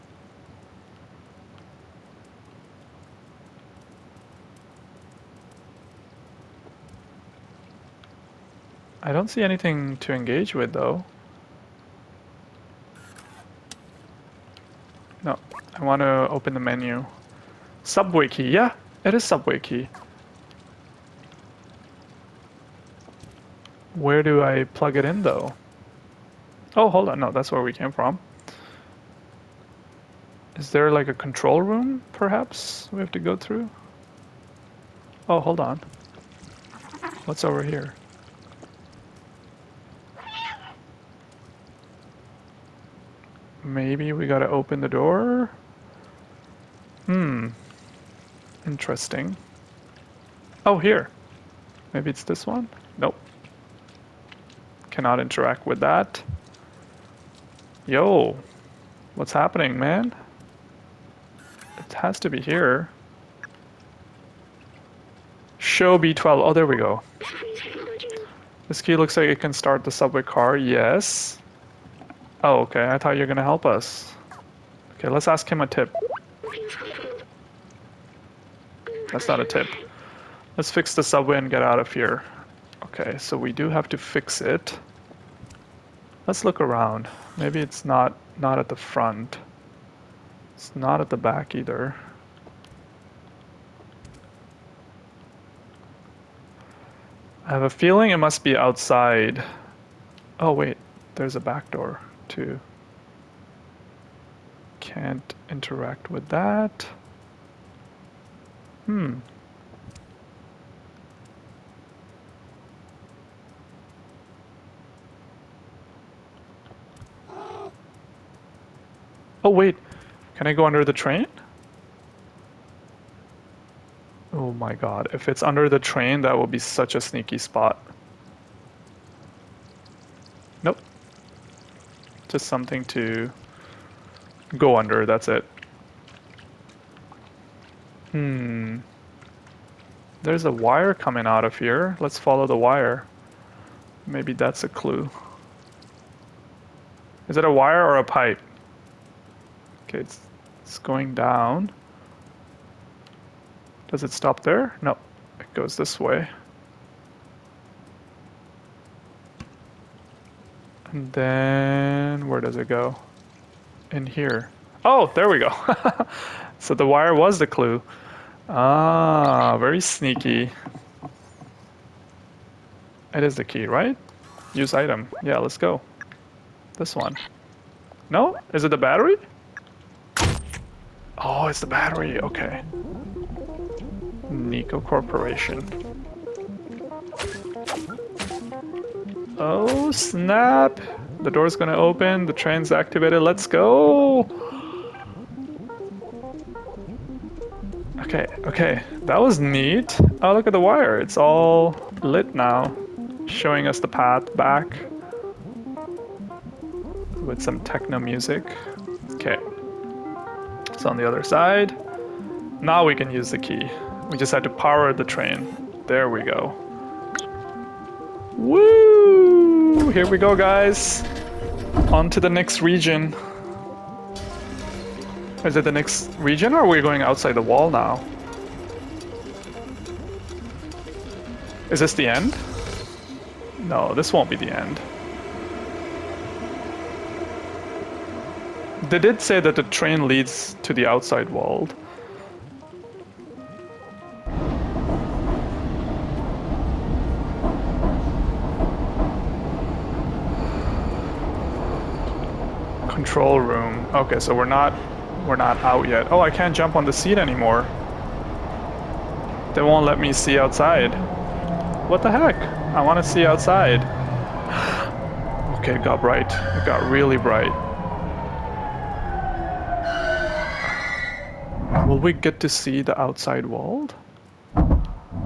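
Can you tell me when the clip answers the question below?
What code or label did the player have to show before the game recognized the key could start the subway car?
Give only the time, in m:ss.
1:05.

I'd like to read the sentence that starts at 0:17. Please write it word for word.
Subway key, yeah, it is subway key.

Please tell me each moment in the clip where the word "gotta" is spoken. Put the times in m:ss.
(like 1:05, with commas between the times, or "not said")
0:44.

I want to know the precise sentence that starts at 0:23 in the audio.
Where do I plug it in though?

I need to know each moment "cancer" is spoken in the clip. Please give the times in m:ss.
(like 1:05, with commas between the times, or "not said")
not said.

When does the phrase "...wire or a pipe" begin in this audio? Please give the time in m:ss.
2:27.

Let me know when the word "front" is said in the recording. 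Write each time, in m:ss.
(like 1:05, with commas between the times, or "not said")
1:28.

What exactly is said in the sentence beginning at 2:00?
Can I go under the train?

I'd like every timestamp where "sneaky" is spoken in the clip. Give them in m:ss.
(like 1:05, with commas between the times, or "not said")
2:07, 2:49.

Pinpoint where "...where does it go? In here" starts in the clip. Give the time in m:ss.
2:42.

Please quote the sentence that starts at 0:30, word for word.
Is there like a control room, perhaps, we have to go through?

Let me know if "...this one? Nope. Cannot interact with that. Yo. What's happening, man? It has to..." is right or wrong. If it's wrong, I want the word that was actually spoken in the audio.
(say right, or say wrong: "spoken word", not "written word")
right.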